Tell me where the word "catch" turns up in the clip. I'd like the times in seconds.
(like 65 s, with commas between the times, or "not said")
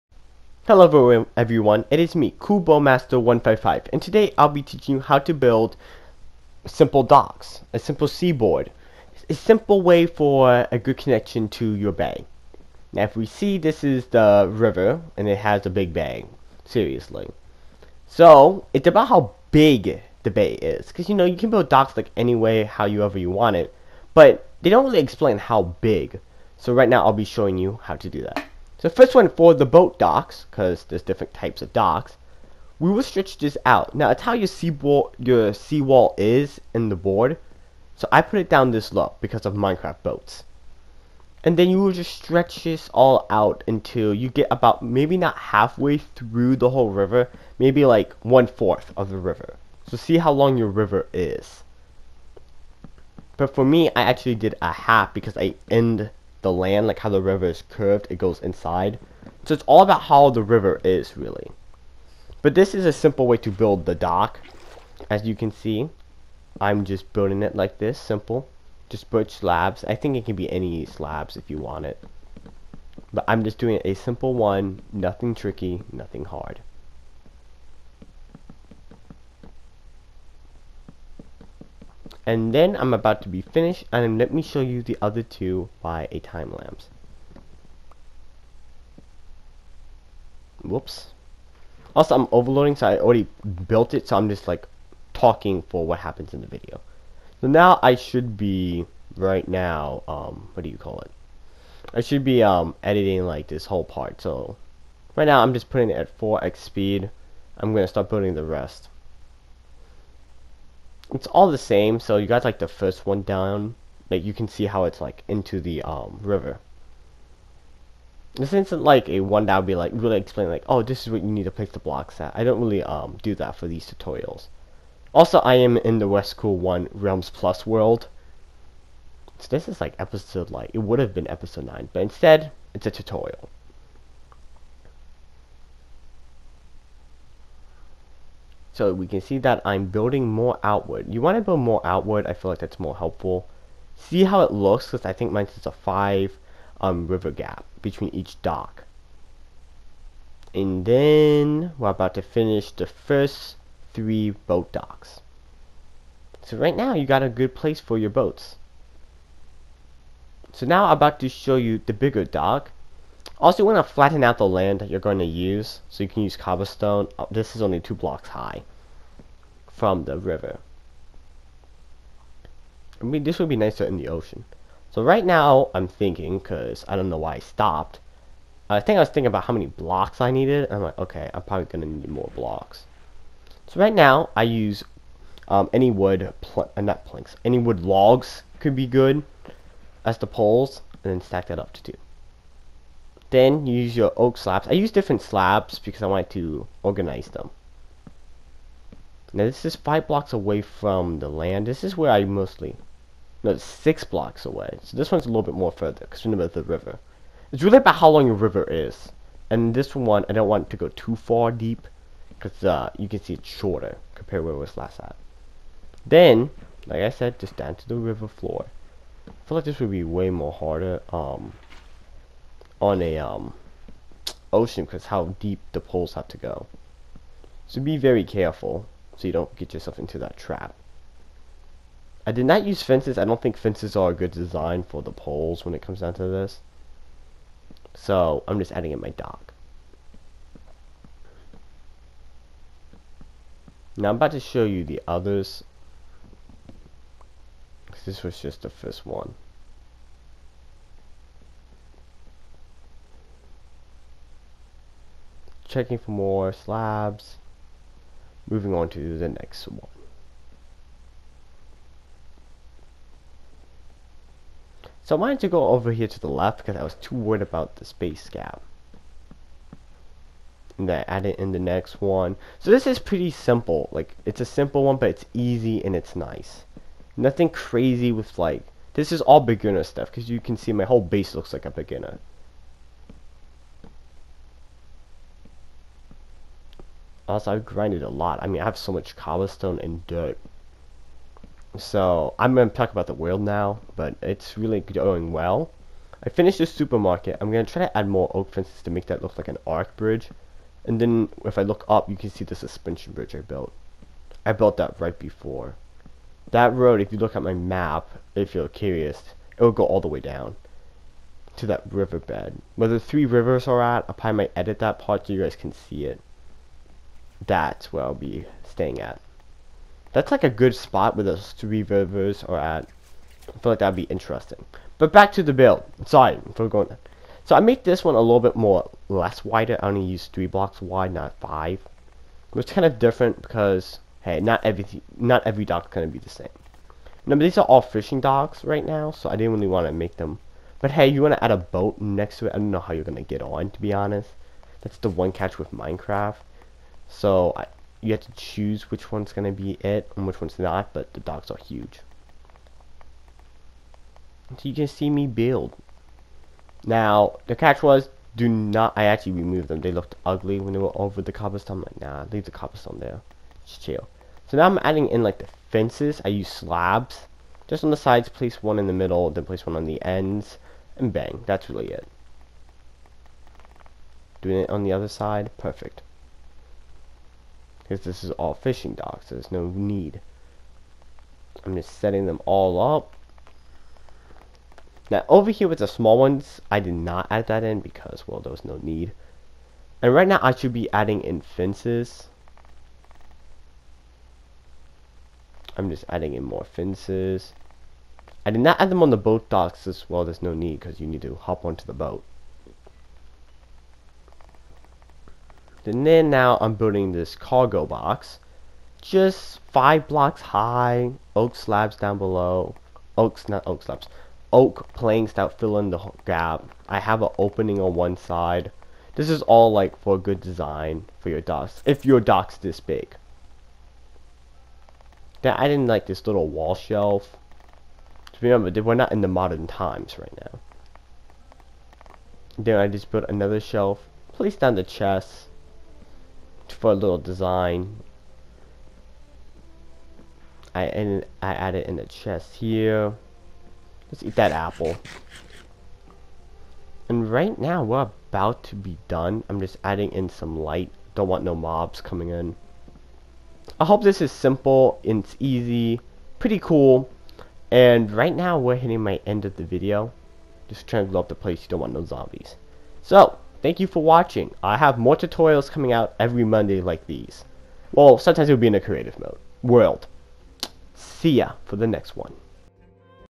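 345 s, 357 s.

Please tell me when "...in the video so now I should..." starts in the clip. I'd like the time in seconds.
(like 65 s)
96 s.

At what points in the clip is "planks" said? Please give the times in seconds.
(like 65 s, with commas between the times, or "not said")
187 s, 414 s.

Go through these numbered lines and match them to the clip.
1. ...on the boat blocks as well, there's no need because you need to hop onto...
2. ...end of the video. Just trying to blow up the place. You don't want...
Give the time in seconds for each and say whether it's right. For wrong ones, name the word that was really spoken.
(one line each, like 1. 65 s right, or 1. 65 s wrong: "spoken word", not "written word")
1. 399 s wrong: "docks", not "blocks"
2. 459 s right.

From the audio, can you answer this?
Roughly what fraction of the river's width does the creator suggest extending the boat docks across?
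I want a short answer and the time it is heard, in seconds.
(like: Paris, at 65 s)
One fourth, at 48 s.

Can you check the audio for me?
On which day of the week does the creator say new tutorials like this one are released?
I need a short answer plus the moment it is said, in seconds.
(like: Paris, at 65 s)
Monday, at 466 s.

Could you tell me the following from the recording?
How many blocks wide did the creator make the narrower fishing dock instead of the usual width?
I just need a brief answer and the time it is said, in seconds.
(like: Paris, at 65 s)
3, at 330 s.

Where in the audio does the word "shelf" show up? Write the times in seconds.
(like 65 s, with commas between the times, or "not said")
426 s, 433 s.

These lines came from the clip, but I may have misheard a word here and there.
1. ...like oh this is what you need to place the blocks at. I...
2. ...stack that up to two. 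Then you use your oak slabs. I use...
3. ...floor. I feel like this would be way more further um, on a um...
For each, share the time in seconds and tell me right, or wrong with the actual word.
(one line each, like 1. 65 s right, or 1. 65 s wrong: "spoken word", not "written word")
1. 120 s right
2. 191 s right
3. 218 s wrong: "harder", not "further".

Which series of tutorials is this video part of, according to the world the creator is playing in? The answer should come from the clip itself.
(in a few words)
West Cool One Realms Plus.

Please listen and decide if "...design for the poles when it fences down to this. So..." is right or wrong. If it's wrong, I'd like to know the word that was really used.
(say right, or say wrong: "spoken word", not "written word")
wrong: "comes", not "fences".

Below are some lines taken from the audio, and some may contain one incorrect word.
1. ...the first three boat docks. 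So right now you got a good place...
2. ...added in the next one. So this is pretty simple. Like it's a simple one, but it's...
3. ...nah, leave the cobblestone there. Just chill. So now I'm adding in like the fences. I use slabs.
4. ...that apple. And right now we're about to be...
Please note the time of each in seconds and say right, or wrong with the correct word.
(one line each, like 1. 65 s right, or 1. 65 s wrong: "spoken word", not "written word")
1. 152 s right
2. 271 s right
3. 362 s right
4. 444 s right.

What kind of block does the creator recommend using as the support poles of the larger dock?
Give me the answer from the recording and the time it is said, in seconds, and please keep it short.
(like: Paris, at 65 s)
Wood logs, at 187 s.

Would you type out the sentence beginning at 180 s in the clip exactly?
I'm like, okay, I'm probably going to need more blocks.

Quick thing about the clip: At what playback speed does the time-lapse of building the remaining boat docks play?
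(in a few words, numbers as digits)
4x.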